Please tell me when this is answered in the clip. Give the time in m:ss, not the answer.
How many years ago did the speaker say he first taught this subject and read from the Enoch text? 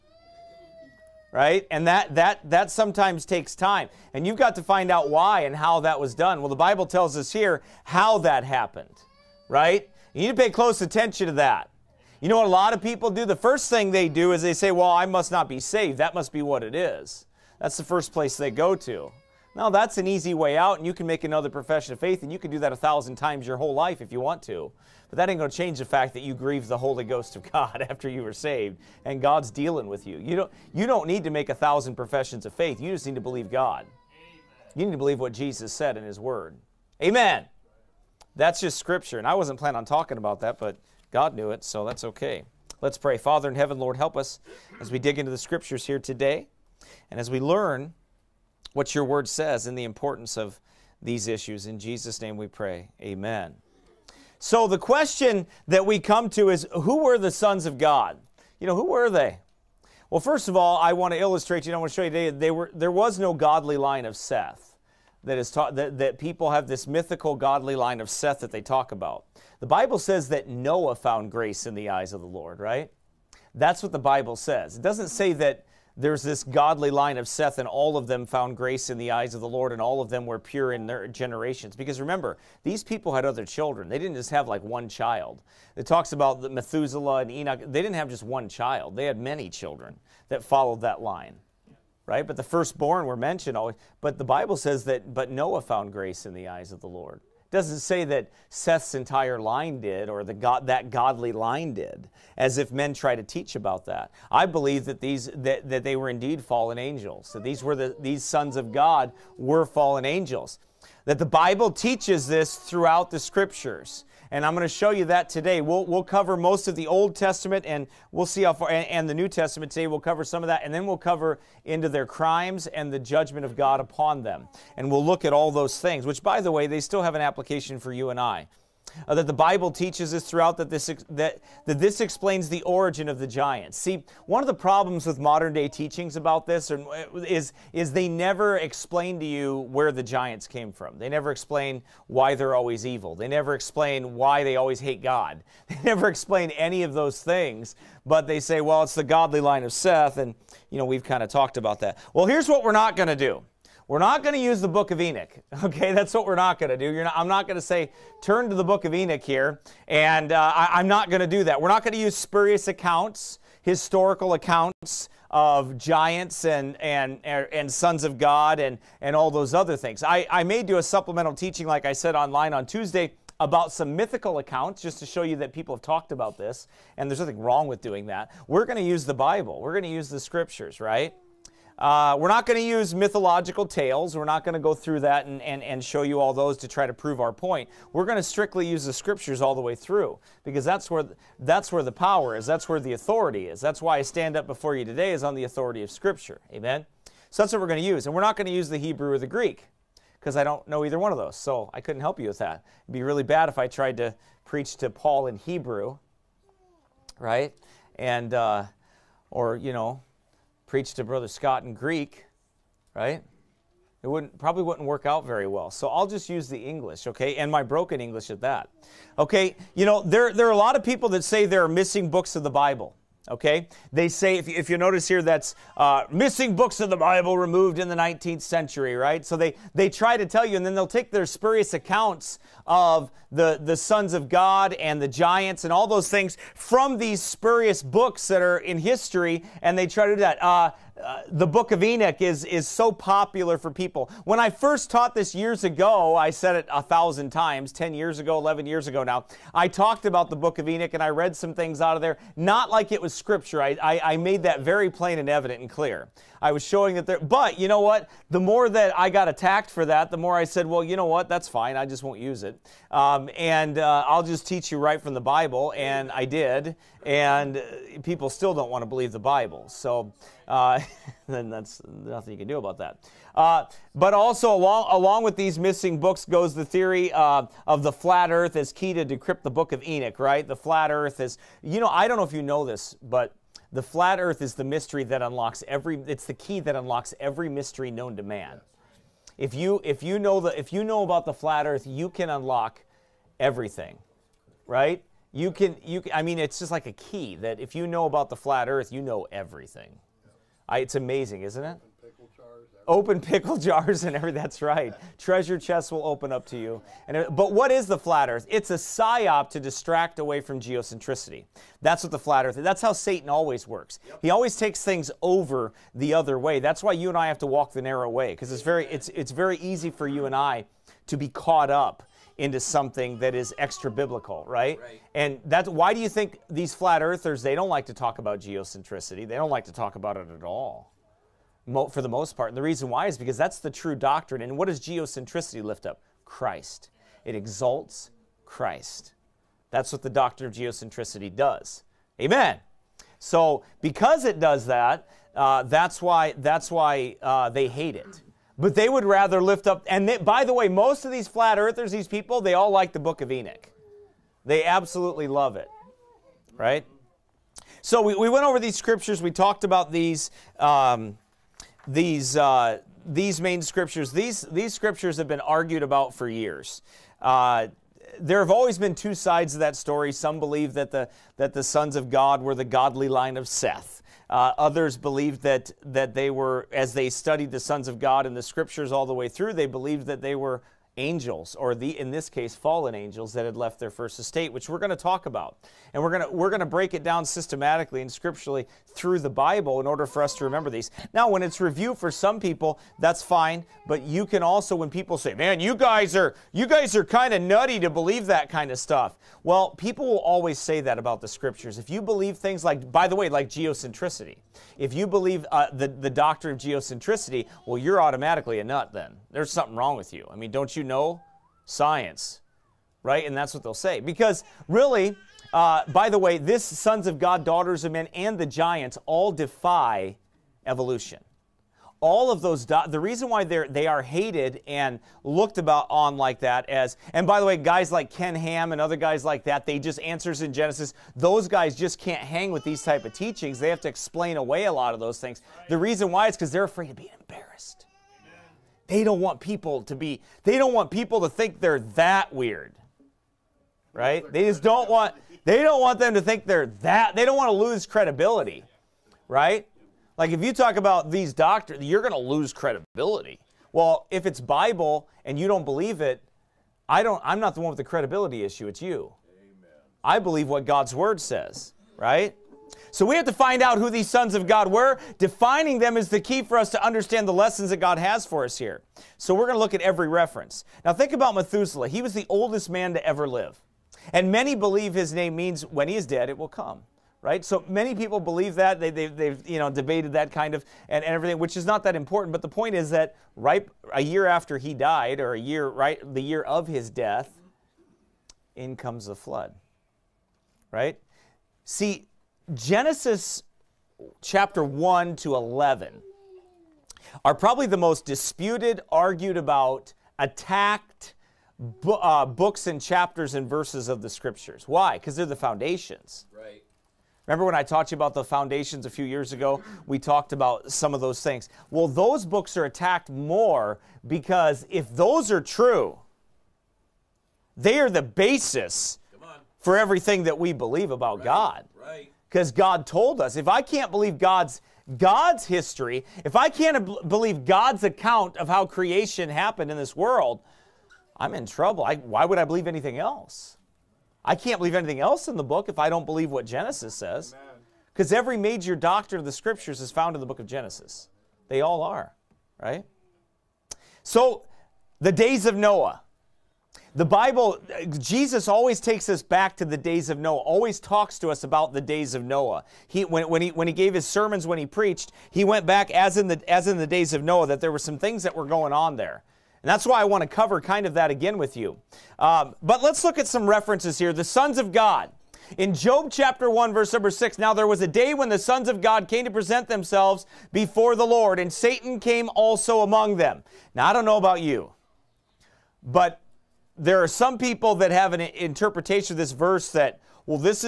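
4:08.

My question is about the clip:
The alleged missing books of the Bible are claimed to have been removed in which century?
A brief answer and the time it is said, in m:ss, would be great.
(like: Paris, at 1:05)
19th century, at 3:47.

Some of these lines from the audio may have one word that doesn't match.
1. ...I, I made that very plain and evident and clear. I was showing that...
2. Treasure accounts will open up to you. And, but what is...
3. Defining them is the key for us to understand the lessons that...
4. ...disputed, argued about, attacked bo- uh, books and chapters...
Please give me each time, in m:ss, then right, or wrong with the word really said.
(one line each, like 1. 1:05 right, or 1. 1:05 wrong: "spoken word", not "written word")
1. 4:13 right
2. 5:05 wrong: "chests", not "accounts"
3. 7:45 right
4. 8:18 right.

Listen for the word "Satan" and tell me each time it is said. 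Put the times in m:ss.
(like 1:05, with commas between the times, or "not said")
5:12, 9:31.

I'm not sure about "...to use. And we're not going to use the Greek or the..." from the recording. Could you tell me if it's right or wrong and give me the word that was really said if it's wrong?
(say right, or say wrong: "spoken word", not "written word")
wrong: "Hebrew", not "Greek".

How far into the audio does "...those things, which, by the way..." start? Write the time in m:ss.
2:05.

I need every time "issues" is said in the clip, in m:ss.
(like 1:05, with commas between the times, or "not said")
0:51, 7:38.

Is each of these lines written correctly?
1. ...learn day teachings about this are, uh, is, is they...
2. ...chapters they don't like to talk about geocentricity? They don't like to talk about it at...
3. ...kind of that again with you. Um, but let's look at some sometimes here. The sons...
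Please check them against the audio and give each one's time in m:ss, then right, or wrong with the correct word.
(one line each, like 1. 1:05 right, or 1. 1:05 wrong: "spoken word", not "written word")
1. 2:15 wrong: "modern", not "learn"
2. 5:27 wrong: "earthers", not "chapters"
3. 9:20 wrong: "references", not "sometimes".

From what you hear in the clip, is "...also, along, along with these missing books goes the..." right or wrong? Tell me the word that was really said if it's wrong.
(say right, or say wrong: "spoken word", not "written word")
right.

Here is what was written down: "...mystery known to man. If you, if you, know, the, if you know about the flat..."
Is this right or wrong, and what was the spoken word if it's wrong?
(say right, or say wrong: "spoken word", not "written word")
right.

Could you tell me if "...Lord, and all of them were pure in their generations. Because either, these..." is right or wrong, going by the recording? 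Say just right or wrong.
wrong.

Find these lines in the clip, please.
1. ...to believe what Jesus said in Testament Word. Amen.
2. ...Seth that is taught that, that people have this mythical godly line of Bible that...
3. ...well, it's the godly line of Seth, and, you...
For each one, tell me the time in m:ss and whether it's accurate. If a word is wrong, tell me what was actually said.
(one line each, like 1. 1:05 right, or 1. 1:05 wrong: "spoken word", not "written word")
1. 0:34 wrong: "His", not "Testament"
2. 1:04 wrong: "Seth", not "Bible"
3. 2:28 right.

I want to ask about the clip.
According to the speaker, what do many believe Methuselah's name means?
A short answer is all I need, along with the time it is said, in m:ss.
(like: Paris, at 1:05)
When he is dead, it will come, at 7:55.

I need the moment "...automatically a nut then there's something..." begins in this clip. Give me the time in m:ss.
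6:48.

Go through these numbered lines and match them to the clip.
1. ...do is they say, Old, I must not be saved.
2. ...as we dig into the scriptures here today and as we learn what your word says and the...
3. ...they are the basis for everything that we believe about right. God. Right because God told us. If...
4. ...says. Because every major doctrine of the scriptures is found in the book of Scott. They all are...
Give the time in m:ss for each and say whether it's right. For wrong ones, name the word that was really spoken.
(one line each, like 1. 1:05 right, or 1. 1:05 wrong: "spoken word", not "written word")
1. 0:14 wrong: "Well", not "Old"
2. 0:44 right
3. 8:37 right
4. 8:56 wrong: "Genesis", not "Scott".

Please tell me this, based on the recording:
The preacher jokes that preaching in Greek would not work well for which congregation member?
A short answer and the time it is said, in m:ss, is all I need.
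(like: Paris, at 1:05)
Brother Scott, at 3:31.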